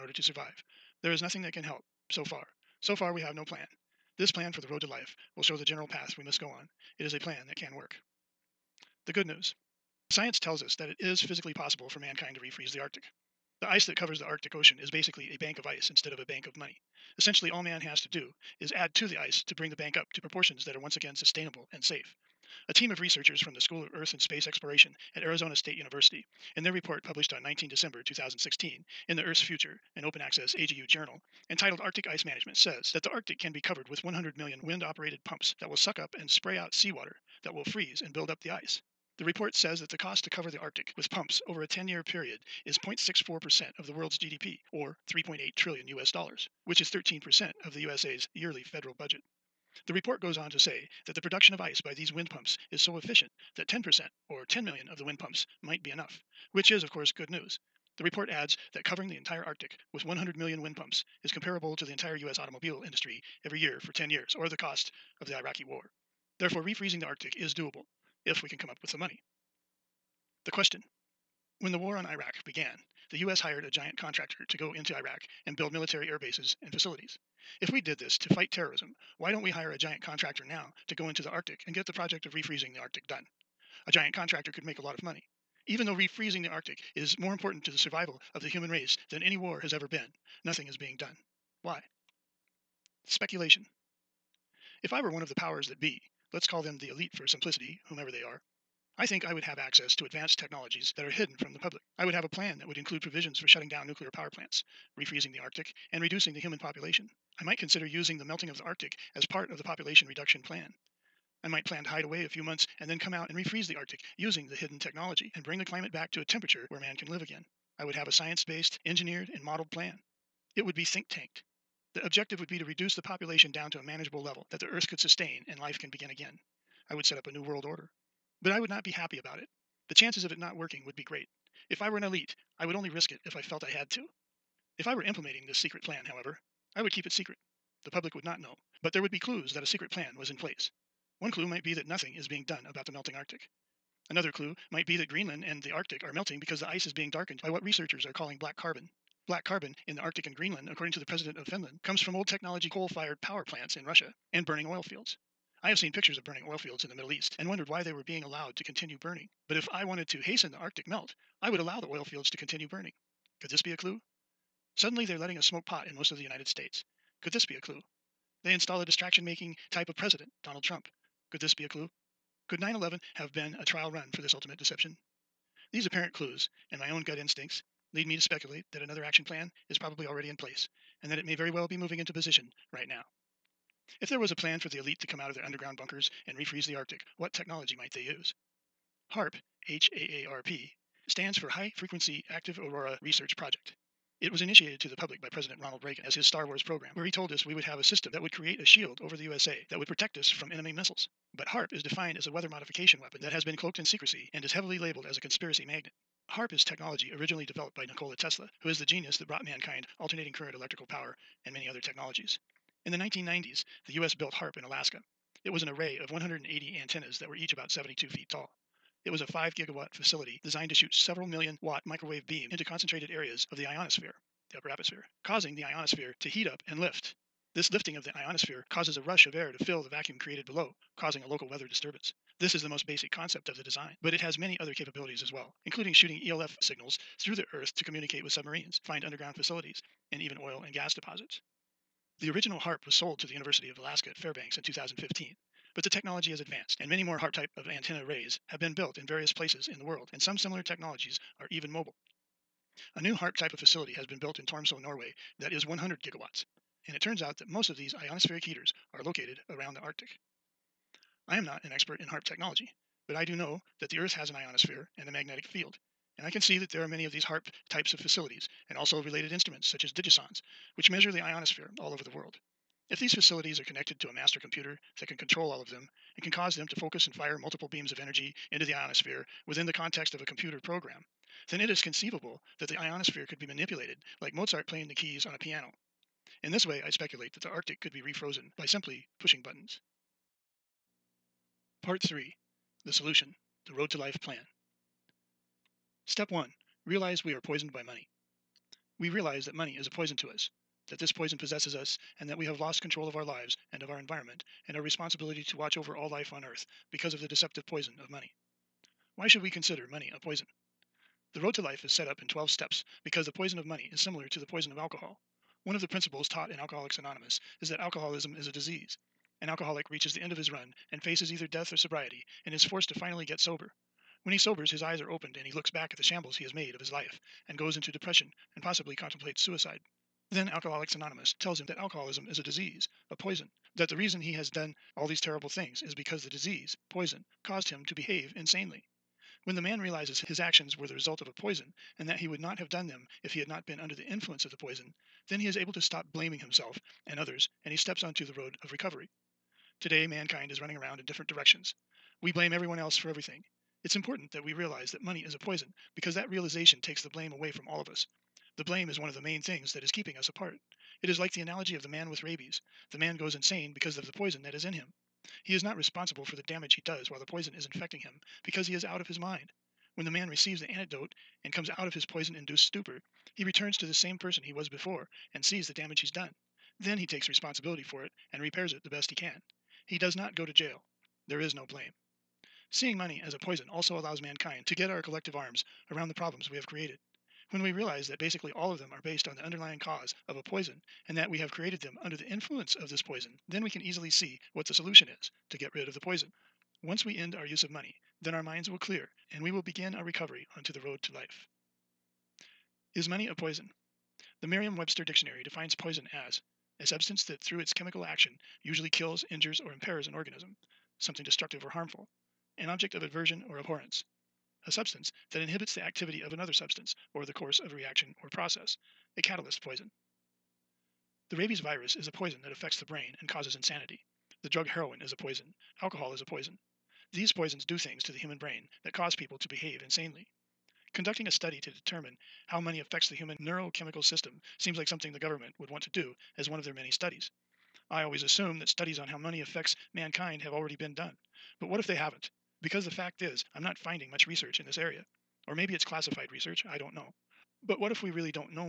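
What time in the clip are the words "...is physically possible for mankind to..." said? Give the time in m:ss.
0:10.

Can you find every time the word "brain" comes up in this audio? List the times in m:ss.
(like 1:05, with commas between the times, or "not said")
7:02, 7:08.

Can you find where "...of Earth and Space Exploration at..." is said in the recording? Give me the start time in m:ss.
0:23.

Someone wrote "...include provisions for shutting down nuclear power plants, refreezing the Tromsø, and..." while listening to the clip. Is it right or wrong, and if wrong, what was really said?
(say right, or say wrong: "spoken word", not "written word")
wrong: "Arctic", not "Tromsø".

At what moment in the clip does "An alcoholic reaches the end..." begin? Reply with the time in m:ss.
5:19.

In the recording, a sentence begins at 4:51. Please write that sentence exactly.
Part 3 The Solution the Road to Life plan.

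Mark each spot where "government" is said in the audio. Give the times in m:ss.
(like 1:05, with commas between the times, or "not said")
7:15.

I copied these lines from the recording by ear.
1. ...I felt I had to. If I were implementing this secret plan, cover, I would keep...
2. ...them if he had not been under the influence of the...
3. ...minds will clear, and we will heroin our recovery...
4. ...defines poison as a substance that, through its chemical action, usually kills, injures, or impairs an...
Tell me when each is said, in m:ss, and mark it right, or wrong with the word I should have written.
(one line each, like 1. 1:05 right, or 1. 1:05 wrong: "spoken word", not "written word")
1. 2:13 wrong: "however", not "cover"
2. 5:42 right
3. 6:38 wrong: "begin", not "heroin"
4. 6:45 right.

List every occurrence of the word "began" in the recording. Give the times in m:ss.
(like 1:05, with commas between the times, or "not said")
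1:12.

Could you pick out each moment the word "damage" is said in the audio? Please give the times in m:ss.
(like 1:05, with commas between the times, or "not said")
6:06, 6:15.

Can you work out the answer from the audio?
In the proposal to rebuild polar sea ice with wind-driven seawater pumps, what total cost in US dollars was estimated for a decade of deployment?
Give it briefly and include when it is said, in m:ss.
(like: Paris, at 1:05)
3.8 trillion US dollars, at 0:45.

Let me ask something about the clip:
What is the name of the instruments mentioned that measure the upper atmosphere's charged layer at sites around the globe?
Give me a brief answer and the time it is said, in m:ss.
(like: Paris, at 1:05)
digisondes, at 4:29.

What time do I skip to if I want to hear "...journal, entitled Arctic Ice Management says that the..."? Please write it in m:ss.
0:30.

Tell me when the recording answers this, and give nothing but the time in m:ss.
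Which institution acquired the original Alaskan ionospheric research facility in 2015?
4:03.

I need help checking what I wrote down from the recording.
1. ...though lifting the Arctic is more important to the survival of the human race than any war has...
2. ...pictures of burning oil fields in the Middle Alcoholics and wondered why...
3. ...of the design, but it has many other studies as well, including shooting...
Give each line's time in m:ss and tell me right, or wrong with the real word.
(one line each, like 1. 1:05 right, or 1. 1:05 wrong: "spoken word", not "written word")
1. 1:25 wrong: "refreezing", not "lifting"
2. 2:35 wrong: "East", not "Alcoholics"
3. 3:53 wrong: "capabilities", not "studies".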